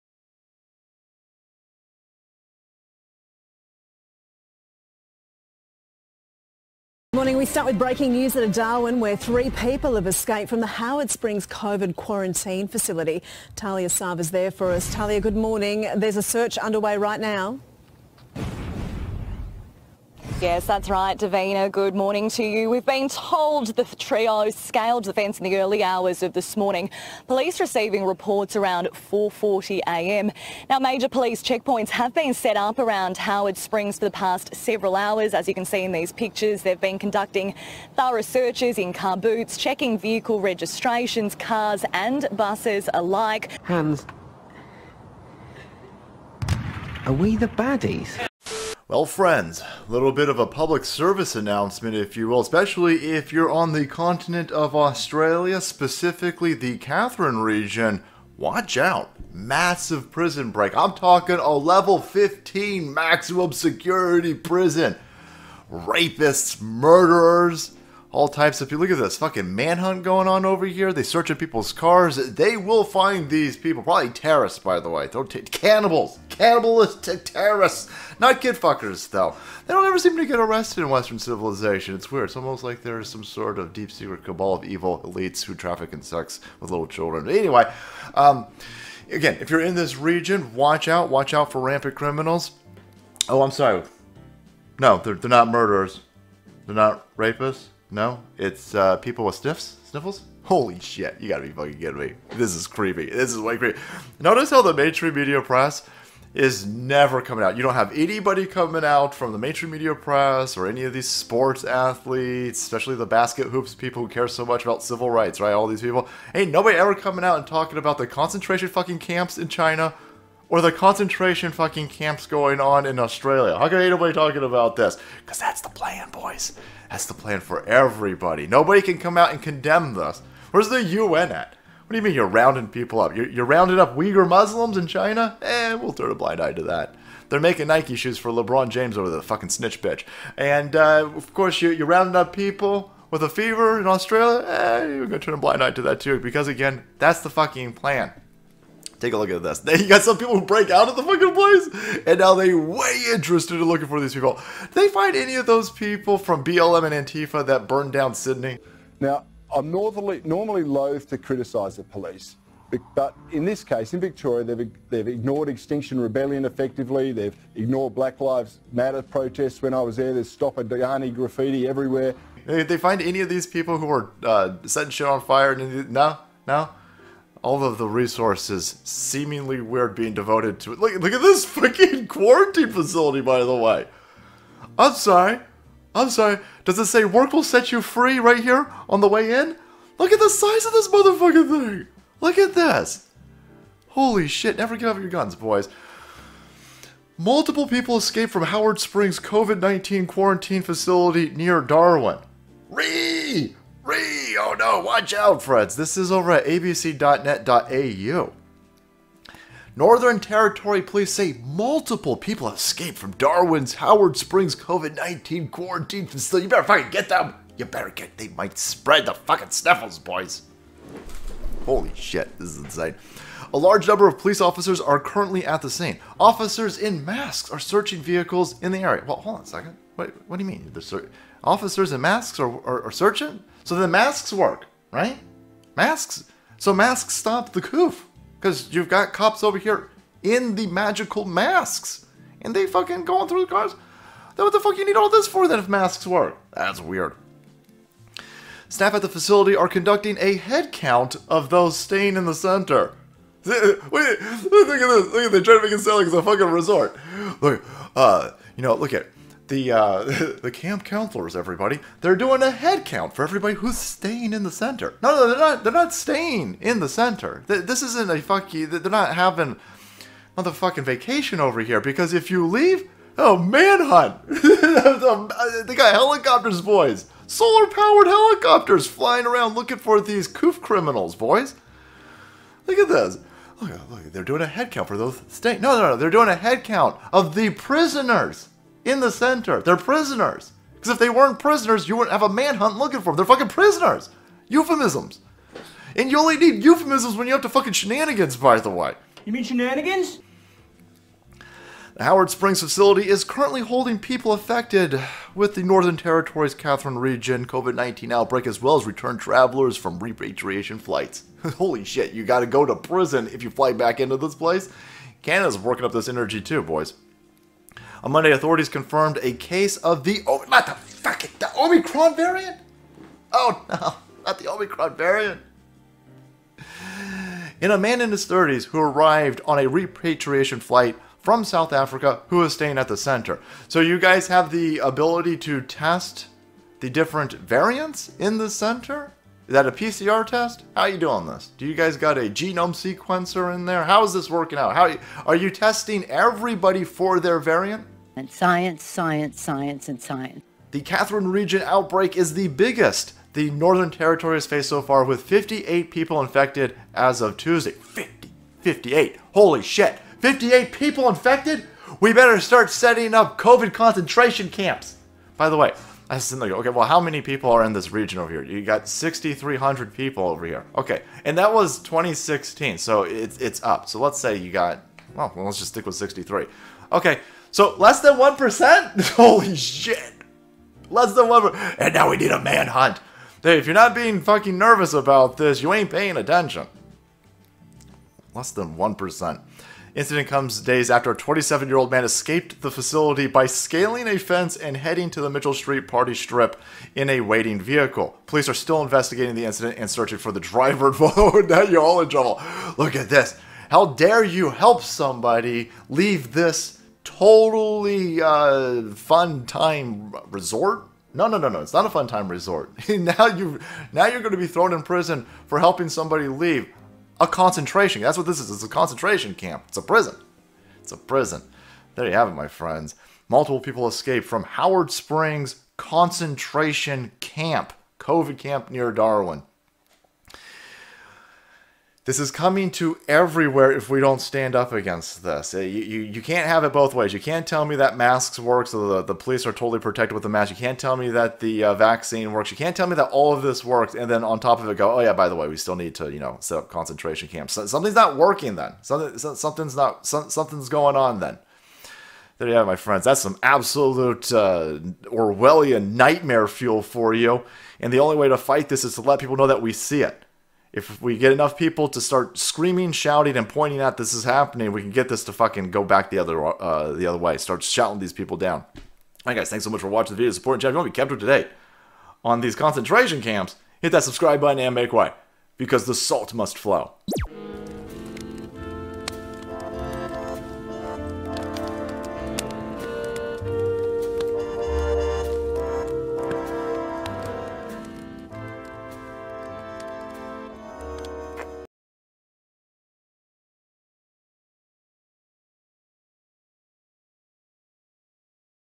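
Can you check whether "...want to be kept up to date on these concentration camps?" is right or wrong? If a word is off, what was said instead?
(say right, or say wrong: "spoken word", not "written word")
right.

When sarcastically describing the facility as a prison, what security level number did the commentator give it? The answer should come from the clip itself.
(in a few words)
15.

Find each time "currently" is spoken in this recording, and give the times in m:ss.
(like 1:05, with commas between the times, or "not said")
3:44, 5:03.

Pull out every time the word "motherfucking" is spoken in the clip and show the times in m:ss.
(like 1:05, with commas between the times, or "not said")
3:10, 4:30.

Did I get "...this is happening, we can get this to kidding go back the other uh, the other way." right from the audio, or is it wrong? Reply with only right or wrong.
wrong.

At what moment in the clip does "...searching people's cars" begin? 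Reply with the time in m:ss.
1:11.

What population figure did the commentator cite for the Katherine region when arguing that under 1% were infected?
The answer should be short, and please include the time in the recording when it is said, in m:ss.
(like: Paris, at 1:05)
6,300, at 6:08.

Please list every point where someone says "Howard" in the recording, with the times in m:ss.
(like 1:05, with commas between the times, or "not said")
0:10, 0:33, 3:18, 3:33, 5:02, 7:04.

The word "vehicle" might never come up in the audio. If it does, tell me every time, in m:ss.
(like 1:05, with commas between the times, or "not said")
0:39, 3:48, 6:37.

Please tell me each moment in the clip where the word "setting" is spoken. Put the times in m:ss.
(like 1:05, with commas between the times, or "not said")
2:54, 6:02.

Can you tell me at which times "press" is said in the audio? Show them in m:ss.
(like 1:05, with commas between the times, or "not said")
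1:45, 1:49.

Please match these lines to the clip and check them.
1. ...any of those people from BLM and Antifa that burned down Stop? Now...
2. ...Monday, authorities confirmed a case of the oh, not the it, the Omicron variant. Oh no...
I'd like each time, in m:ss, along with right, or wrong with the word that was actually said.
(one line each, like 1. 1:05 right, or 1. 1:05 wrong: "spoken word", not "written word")
1. 2:35 wrong: "Sydney", not "Stop"
2. 5:18 right.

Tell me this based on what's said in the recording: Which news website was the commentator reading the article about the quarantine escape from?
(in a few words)
abc.net.au.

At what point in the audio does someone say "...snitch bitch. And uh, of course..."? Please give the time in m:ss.
2:19.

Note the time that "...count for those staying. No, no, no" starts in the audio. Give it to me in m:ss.
4:44.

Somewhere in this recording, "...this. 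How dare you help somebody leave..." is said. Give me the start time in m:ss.
6:43.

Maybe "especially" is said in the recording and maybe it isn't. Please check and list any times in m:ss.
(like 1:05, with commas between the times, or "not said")
0:52, 1:52.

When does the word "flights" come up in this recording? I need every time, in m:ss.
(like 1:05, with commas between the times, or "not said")
5:10, 5:30.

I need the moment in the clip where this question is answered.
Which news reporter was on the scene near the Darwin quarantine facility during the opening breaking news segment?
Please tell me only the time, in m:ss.
0:13.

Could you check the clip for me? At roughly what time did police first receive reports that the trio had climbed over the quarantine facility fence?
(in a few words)
4.40am.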